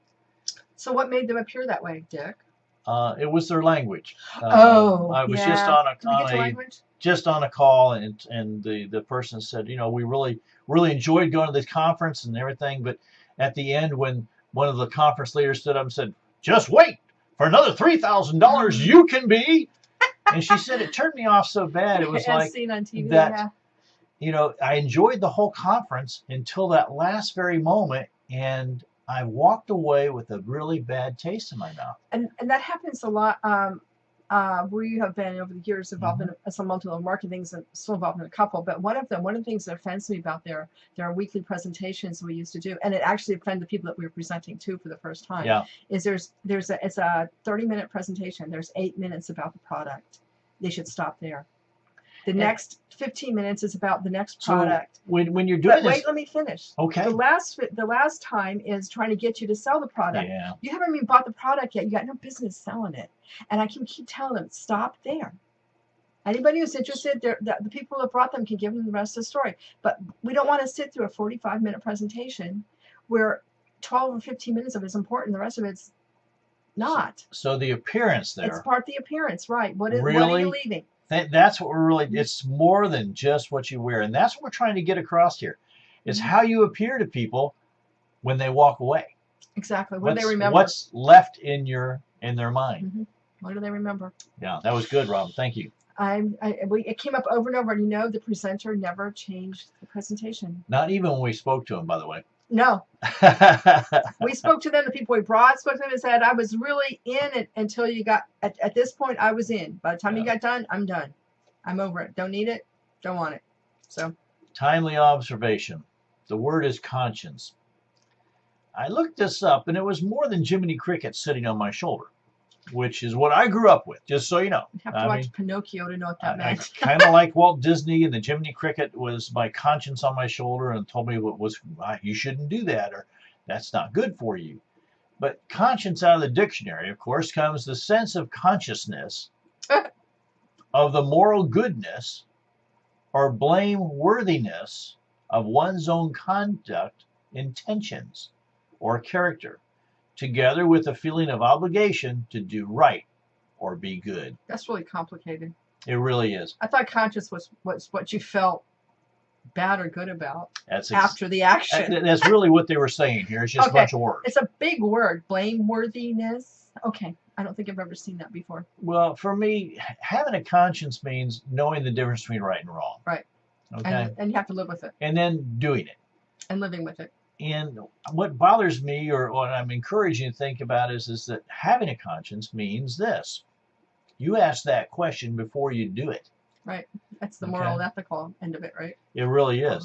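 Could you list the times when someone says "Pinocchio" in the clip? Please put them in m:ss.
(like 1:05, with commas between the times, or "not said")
2:05.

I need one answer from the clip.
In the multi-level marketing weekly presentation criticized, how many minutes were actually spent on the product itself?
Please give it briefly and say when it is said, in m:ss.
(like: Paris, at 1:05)
8, at 0:48.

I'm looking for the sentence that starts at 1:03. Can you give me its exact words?
And I can keep telling them, stop there.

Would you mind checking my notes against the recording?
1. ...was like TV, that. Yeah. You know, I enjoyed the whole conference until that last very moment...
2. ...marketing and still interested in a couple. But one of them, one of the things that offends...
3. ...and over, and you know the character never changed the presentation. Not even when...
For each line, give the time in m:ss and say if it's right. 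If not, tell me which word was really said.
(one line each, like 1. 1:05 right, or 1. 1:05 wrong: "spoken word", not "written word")
1. 0:22 right
2. 0:36 wrong: "involved", not "interested"
3. 1:37 wrong: "presenter", not "character".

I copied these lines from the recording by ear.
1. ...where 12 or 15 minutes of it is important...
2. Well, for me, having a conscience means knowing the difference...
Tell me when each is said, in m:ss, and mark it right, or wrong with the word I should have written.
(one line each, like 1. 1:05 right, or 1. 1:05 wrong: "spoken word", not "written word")
1. 1:13 right
2. 2:48 right.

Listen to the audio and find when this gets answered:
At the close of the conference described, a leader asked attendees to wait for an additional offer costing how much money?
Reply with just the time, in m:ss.
0:17.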